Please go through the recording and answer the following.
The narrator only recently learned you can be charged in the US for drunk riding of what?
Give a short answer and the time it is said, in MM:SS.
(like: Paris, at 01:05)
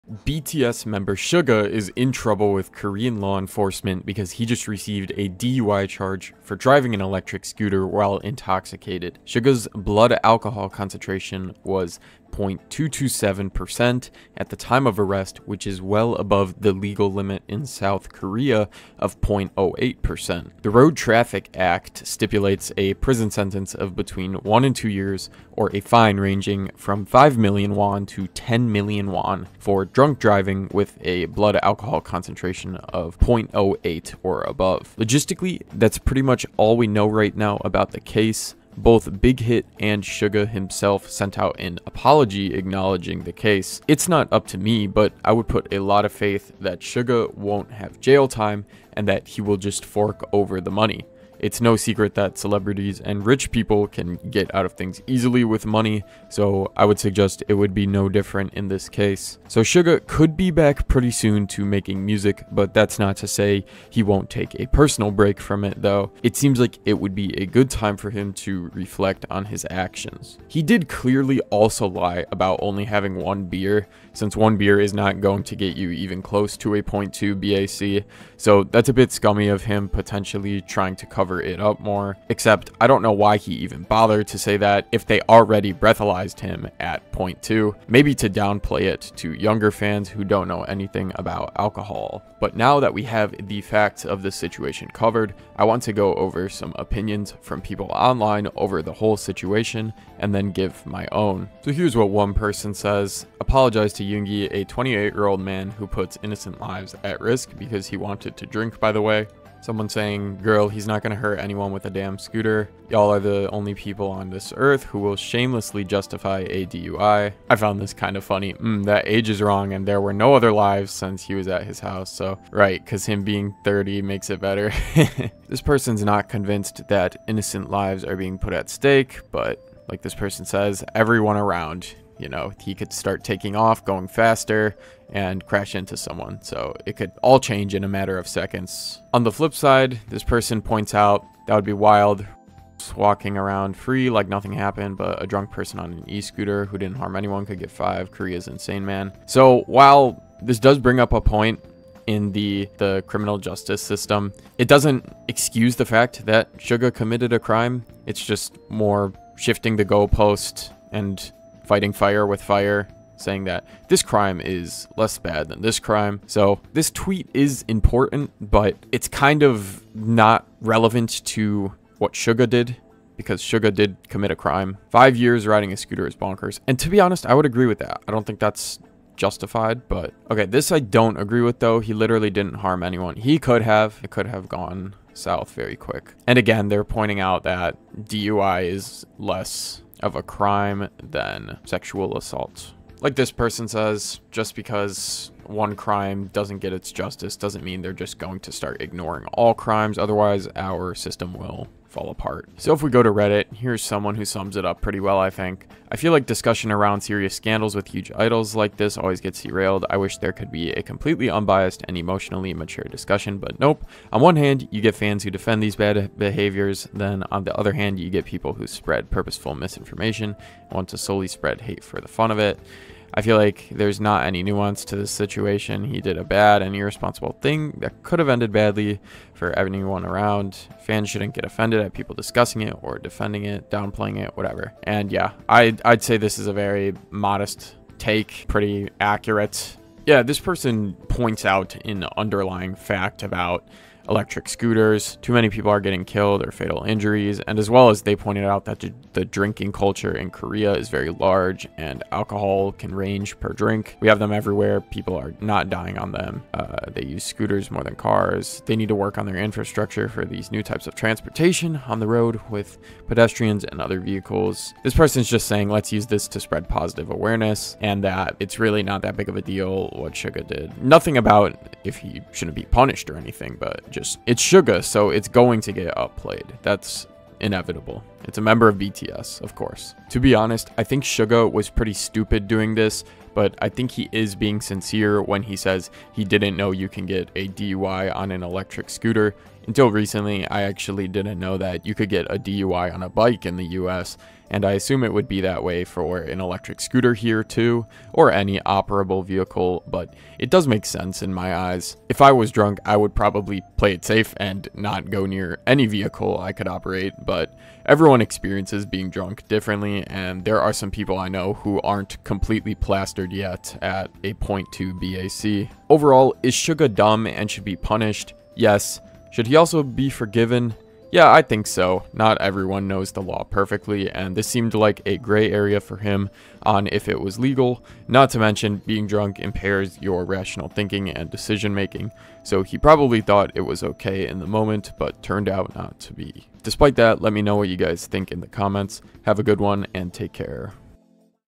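A bike, at 04:53.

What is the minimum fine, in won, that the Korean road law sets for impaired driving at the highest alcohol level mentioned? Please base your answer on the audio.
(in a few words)
5 million won.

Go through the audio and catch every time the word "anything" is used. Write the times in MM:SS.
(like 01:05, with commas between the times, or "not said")
01:30, 04:33.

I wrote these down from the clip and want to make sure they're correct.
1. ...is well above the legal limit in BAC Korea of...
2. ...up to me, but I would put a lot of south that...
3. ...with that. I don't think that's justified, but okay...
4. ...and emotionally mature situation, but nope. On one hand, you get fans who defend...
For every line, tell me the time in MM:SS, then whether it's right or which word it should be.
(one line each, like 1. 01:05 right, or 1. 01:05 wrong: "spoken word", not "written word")
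1. 00:15 wrong: "South", not "BAC"
2. 00:44 wrong: "faith", not "south"
3. 02:57 right
4. 03:31 wrong: "discussion", not "situation".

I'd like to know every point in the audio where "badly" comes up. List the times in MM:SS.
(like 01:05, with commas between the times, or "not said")
03:48.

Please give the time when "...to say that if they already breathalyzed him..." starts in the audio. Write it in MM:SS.
01:24.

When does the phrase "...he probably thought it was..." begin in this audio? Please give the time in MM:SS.
05:32.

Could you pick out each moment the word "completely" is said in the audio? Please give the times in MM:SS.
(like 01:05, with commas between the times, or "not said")
03:30, 05:12.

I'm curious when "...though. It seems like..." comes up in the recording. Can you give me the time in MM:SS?
01:05.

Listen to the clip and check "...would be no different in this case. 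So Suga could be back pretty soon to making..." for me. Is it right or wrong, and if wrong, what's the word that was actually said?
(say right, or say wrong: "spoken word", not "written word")
right.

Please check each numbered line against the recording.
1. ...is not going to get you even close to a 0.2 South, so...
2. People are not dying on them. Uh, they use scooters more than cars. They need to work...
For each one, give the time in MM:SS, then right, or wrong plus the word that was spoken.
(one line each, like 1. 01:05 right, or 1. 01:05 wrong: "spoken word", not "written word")
1. 01:14 wrong: "BAC", not "South"
2. 04:14 right.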